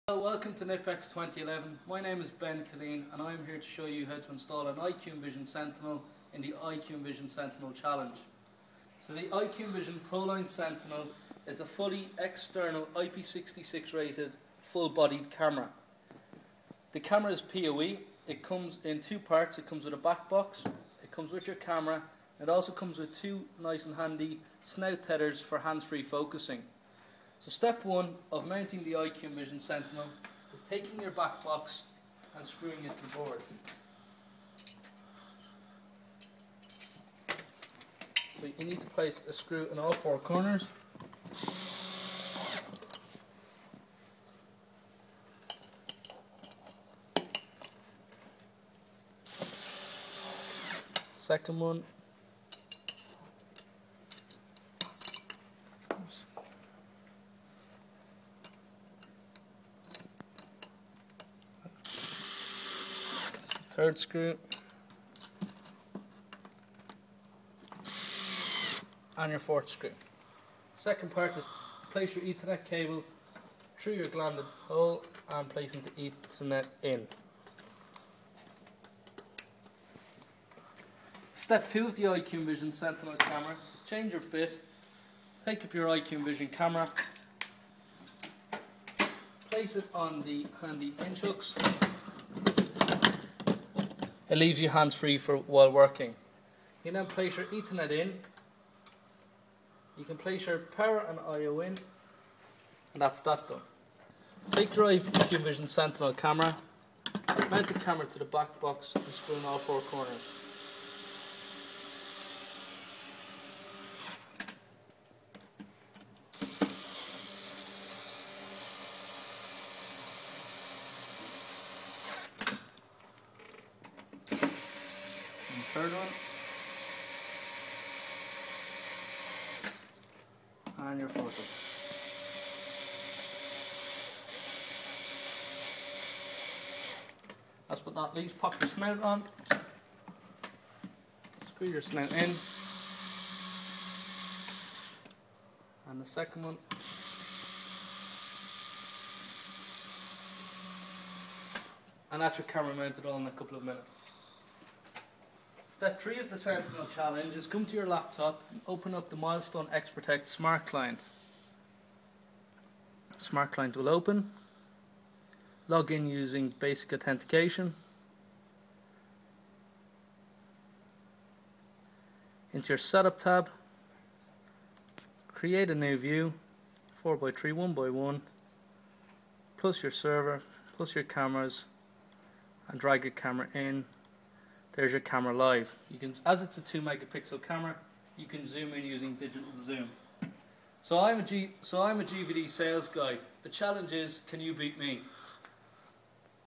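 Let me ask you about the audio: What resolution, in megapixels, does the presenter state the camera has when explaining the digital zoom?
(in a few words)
2 megapixel.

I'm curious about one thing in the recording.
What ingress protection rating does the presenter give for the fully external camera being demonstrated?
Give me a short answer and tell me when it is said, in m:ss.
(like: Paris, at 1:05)
IP66, at 0:12.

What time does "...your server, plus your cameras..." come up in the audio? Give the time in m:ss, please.
2:59.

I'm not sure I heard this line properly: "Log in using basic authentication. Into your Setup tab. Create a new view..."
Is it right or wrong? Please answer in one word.
right.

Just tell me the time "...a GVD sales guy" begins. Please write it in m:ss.
3:11.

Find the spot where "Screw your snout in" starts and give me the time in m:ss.
2:21.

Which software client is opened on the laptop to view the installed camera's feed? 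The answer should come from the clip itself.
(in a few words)
Milestone XProtect Smart Client.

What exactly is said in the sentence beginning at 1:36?
You then place your Ethernet in.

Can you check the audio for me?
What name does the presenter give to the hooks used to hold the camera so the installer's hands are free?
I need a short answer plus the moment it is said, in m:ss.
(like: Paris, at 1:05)
pinch hooks, at 1:30.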